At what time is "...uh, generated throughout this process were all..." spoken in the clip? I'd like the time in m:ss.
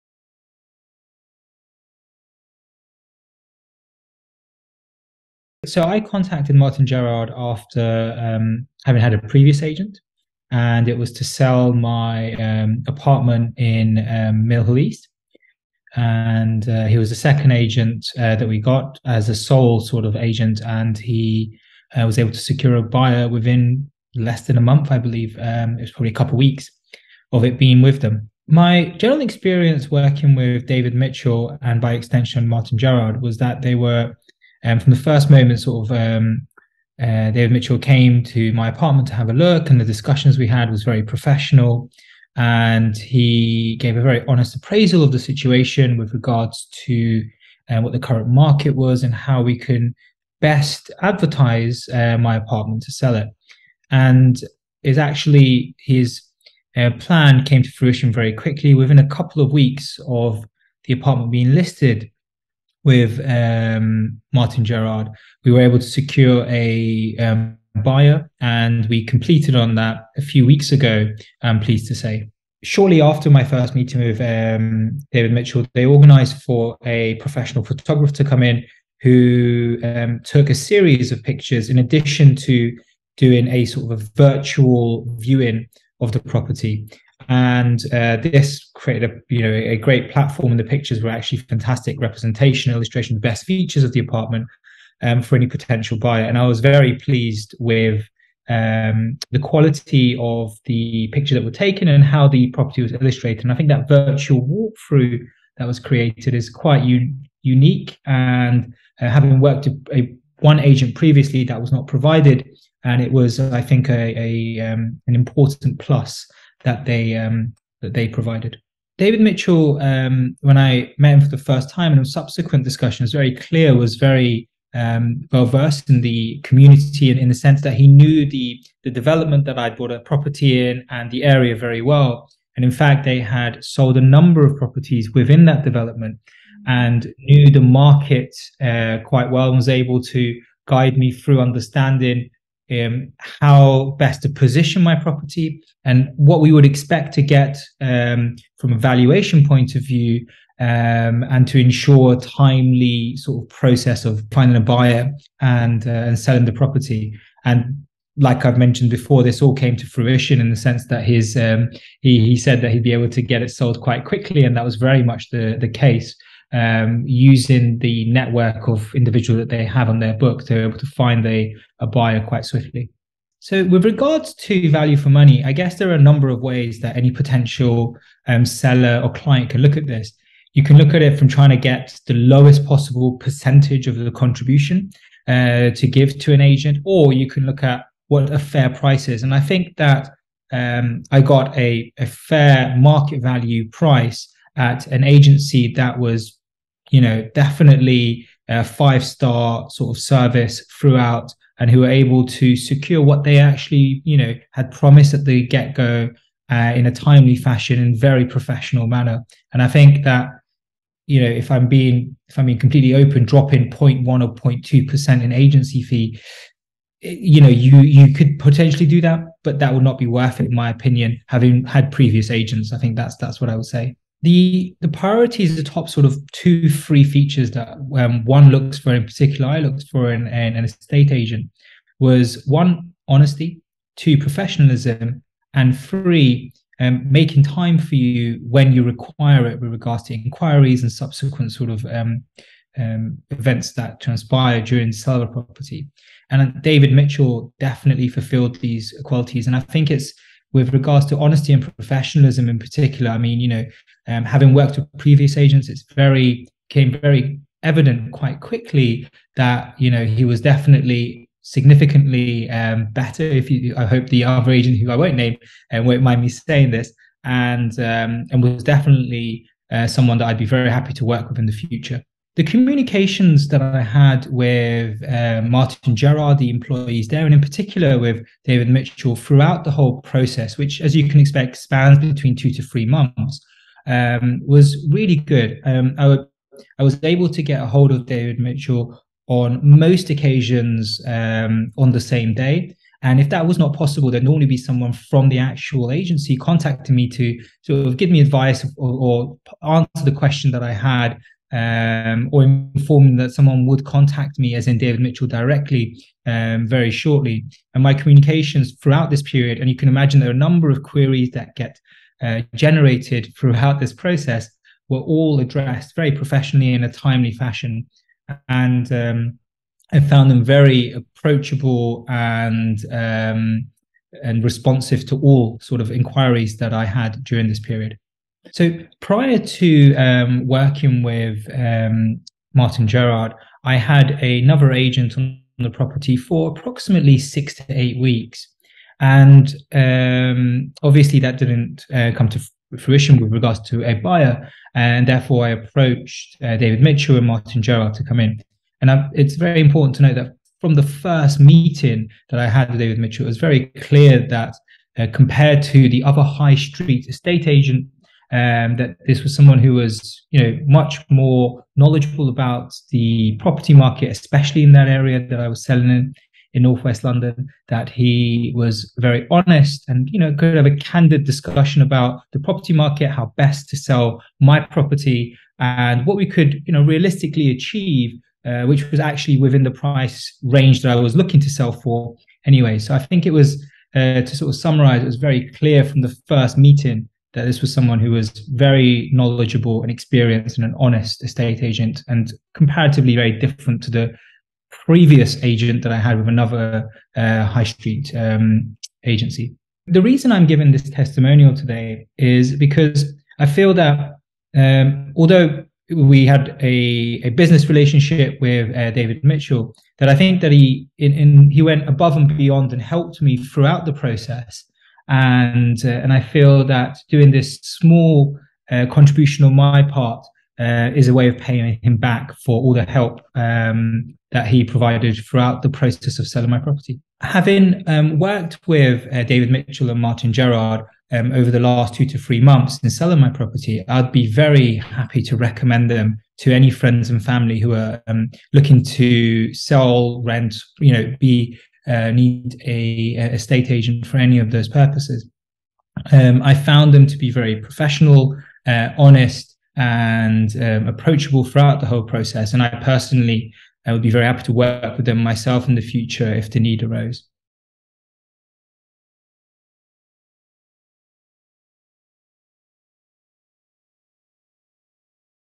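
5:12.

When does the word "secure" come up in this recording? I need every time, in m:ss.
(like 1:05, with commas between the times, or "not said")
0:22, 1:05, 3:22.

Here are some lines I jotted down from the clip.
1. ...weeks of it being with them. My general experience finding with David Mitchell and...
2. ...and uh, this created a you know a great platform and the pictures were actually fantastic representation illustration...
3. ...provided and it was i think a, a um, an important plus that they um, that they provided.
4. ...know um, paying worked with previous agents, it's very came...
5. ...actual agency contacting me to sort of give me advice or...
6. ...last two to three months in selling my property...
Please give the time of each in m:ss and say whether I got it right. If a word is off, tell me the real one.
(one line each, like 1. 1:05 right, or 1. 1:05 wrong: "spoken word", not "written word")
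1. 0:26 wrong: "working", not "finding"
2. 1:27 right
3. 1:51 right
4. 4:13 wrong: "having", not "paying"
5. 4:55 right
6. 7:11 right.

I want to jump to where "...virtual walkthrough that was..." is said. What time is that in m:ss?
1:43.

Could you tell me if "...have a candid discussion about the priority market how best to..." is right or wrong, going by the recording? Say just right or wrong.
wrong.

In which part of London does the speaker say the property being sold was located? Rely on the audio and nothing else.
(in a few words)
northwest London.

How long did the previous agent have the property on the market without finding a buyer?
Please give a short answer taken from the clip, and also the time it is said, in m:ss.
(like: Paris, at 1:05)
6 to 8 weeks, at 5:37.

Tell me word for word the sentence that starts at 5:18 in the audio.
And um, I found them very approachable and um, and responsive to all sort of inquiries that I had during this period.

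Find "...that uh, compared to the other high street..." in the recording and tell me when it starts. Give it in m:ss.
5:54.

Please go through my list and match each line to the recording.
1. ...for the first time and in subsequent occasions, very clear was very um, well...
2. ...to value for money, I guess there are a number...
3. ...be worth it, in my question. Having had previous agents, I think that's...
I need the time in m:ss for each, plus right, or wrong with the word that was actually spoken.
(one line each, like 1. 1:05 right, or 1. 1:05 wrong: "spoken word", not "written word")
1. 2:01 wrong: "discussions", not "occasions"
2. 2:54 right
3. 3:39 wrong: "opinion", not "question".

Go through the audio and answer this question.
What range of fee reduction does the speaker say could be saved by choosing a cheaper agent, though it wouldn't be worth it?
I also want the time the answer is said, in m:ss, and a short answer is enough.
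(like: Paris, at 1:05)
0.1 or 0.2 percent, at 3:33.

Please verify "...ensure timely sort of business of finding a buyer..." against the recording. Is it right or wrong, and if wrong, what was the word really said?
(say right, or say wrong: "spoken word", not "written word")
wrong: "process", not "business".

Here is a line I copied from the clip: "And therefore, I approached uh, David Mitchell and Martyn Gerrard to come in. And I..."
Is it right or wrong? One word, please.
right.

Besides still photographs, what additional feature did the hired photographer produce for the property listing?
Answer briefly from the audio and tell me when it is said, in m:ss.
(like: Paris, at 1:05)
virtual viewing, at 1:24.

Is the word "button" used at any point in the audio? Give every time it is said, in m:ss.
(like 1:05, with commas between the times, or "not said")
not said.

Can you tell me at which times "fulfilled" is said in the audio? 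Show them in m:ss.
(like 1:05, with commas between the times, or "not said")
4:08.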